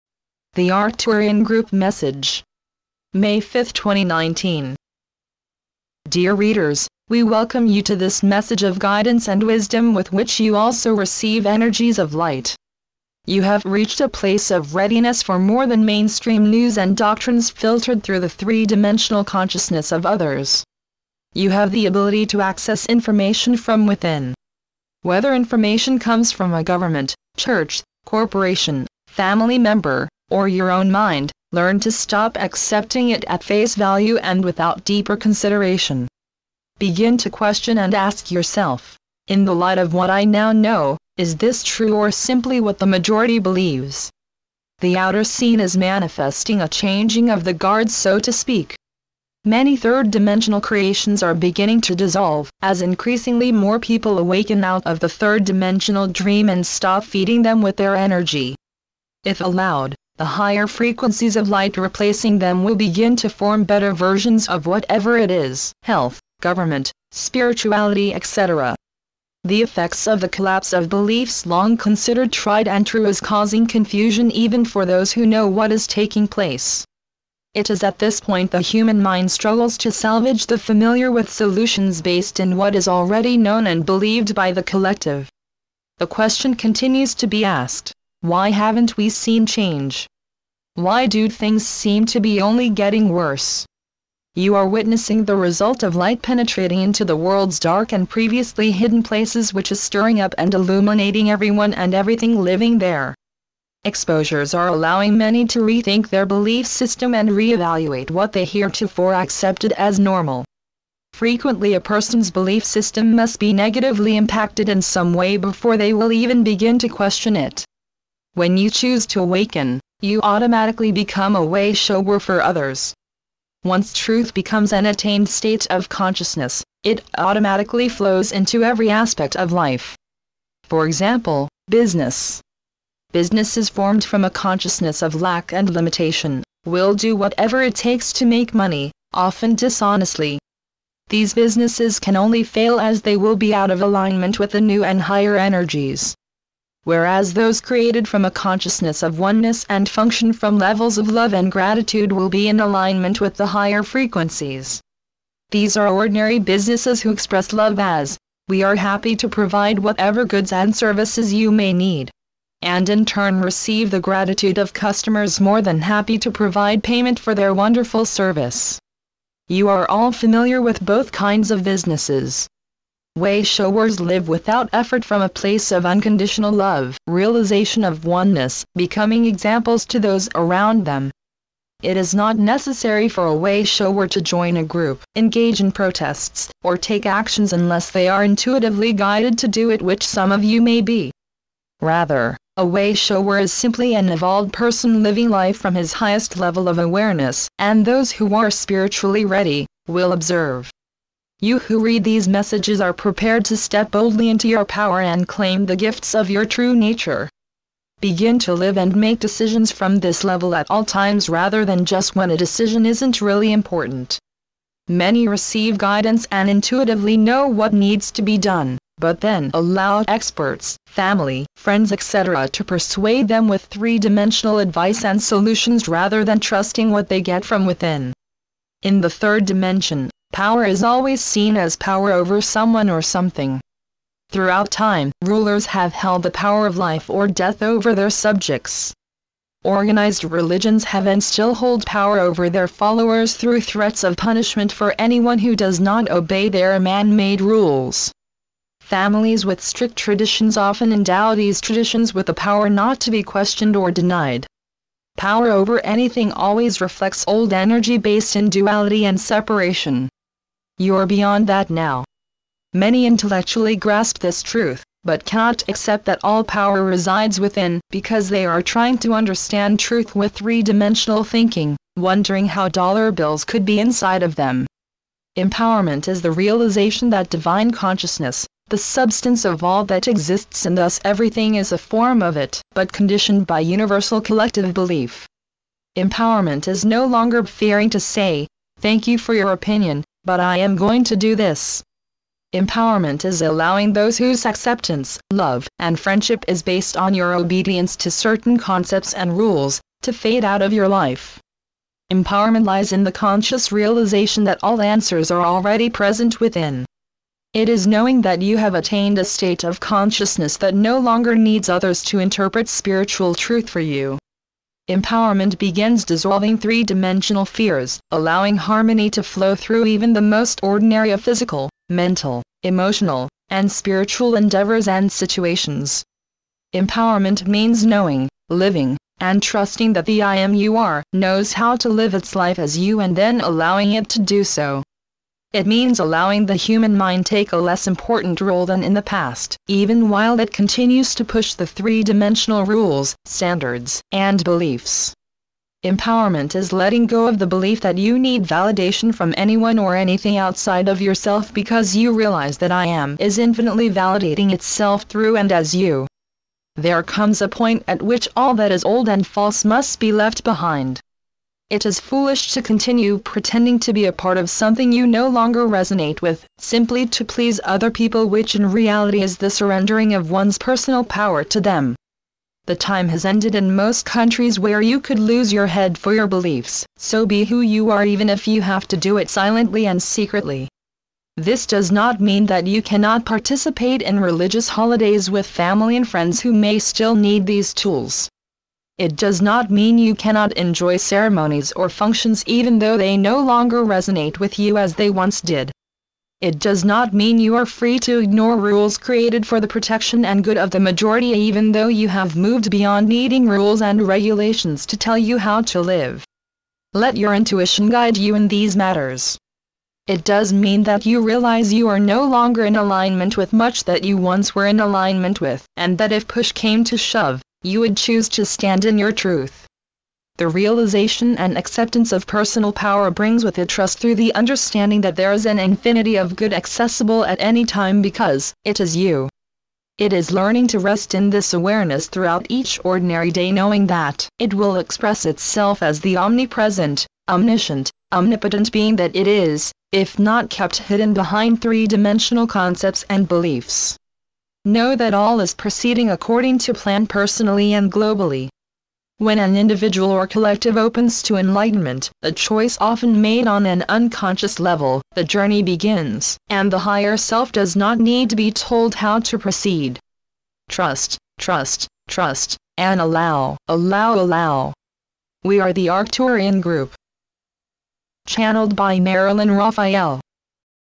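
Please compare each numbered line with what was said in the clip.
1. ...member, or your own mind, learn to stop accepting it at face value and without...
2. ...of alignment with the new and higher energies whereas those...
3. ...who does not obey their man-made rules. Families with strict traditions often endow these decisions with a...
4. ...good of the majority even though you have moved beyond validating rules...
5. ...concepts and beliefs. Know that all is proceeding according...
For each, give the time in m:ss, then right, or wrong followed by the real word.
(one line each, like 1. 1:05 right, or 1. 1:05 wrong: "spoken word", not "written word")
1. 0:29 right
2. 2:23 right
3. 4:05 wrong: "traditions", not "decisions"
4. 6:40 wrong: "needing", not "validating"
5. 7:22 right.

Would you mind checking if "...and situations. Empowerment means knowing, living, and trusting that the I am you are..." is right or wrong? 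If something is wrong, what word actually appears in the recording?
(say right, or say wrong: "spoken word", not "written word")
right.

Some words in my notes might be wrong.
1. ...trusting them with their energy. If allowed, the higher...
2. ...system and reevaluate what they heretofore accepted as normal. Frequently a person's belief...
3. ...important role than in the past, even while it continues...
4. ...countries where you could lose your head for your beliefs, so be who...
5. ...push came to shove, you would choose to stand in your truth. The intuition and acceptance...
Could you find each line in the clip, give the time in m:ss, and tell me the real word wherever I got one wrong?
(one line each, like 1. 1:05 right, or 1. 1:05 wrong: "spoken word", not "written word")
1. 0:57 wrong: "feeding", not "trusting"
2. 1:46 right
3. 5:37 right
4. 6:14 right
5. 6:56 wrong: "realization", not "intuition".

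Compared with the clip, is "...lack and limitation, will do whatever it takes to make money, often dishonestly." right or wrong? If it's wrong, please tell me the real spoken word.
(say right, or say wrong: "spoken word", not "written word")
right.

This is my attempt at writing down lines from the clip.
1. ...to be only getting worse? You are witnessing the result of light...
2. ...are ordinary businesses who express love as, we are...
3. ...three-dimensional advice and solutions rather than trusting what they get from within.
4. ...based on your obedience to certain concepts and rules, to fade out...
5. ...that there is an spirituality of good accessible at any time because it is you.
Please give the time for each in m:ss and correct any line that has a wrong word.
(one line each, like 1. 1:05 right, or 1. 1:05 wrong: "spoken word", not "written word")
1. 1:32 right
2. 2:35 right
3. 3:43 right
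4. 4:56 right
5. 7:05 wrong: "infinity", not "spirituality".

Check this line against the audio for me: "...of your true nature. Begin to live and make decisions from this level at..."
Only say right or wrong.
right.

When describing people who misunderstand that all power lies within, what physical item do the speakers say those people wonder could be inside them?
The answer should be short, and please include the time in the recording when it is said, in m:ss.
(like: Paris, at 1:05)
Dollar bills, at 4:32.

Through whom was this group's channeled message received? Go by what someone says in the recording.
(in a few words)
Marilyn Raffaelle.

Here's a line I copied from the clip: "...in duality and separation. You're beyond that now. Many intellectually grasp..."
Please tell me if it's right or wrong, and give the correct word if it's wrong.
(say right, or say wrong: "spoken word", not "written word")
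right.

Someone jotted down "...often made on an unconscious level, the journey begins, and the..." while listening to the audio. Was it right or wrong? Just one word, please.
right.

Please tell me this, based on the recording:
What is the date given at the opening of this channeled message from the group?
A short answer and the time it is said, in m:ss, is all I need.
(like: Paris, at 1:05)
May 5, 2019, at 0:03.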